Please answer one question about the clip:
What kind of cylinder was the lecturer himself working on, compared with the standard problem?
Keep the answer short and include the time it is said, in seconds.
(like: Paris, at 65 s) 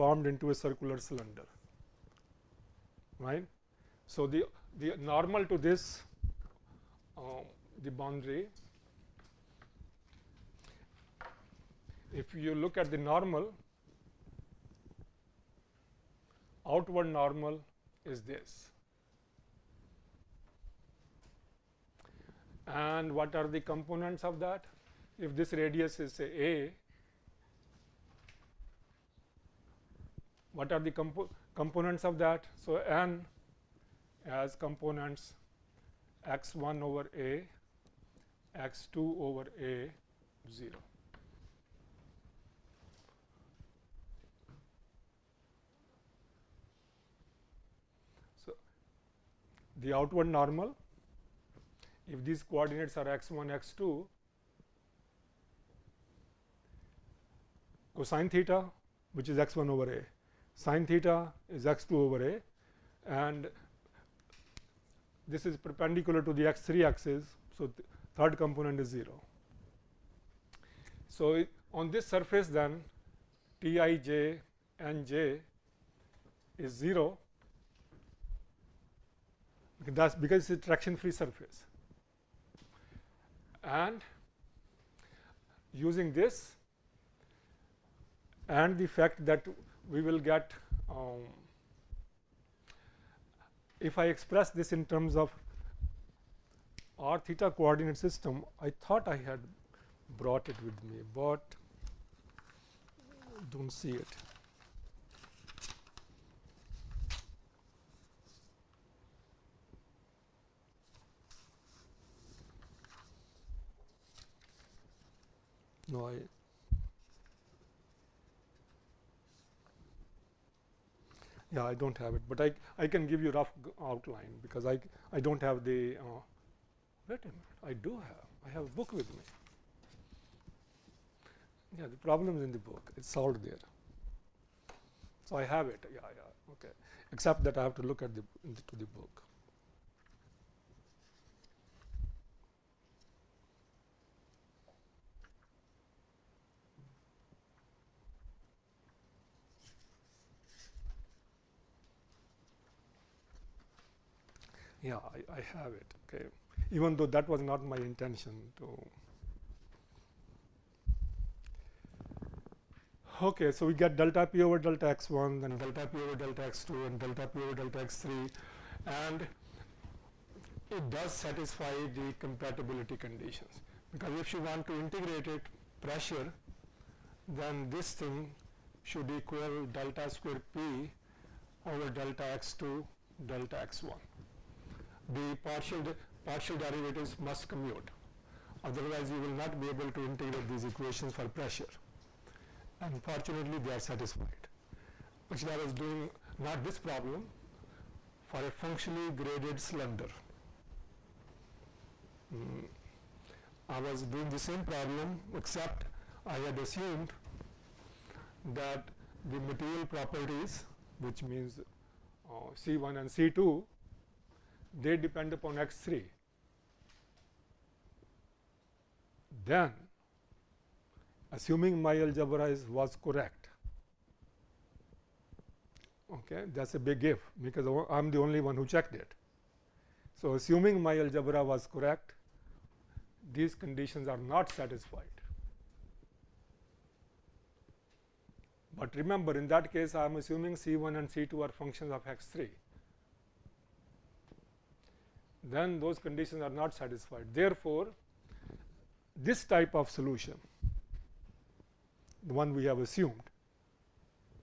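functionally graded cylinder, at 198 s.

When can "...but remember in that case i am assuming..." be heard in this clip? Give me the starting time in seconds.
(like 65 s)
238 s.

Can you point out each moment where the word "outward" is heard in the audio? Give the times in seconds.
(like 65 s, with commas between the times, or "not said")
16 s, 49 s.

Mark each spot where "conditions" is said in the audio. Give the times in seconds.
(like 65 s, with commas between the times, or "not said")
172 s, 233 s, 245 s.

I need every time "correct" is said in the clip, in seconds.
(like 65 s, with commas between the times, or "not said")
223 s, 231 s.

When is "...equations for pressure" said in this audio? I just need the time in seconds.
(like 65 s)
190 s.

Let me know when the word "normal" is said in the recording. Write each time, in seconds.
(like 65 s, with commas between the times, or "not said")
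4 s, 12 s, 17 s, 50 s.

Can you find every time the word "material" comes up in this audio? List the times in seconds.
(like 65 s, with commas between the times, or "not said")
209 s.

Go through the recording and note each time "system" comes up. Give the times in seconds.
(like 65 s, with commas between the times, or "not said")
98 s.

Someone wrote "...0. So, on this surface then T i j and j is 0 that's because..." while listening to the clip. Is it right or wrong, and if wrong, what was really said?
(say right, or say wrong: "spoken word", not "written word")
right.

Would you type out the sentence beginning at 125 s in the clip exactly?
Uh, wait a minute, I do have.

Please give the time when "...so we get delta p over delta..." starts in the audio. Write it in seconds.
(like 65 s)
163 s.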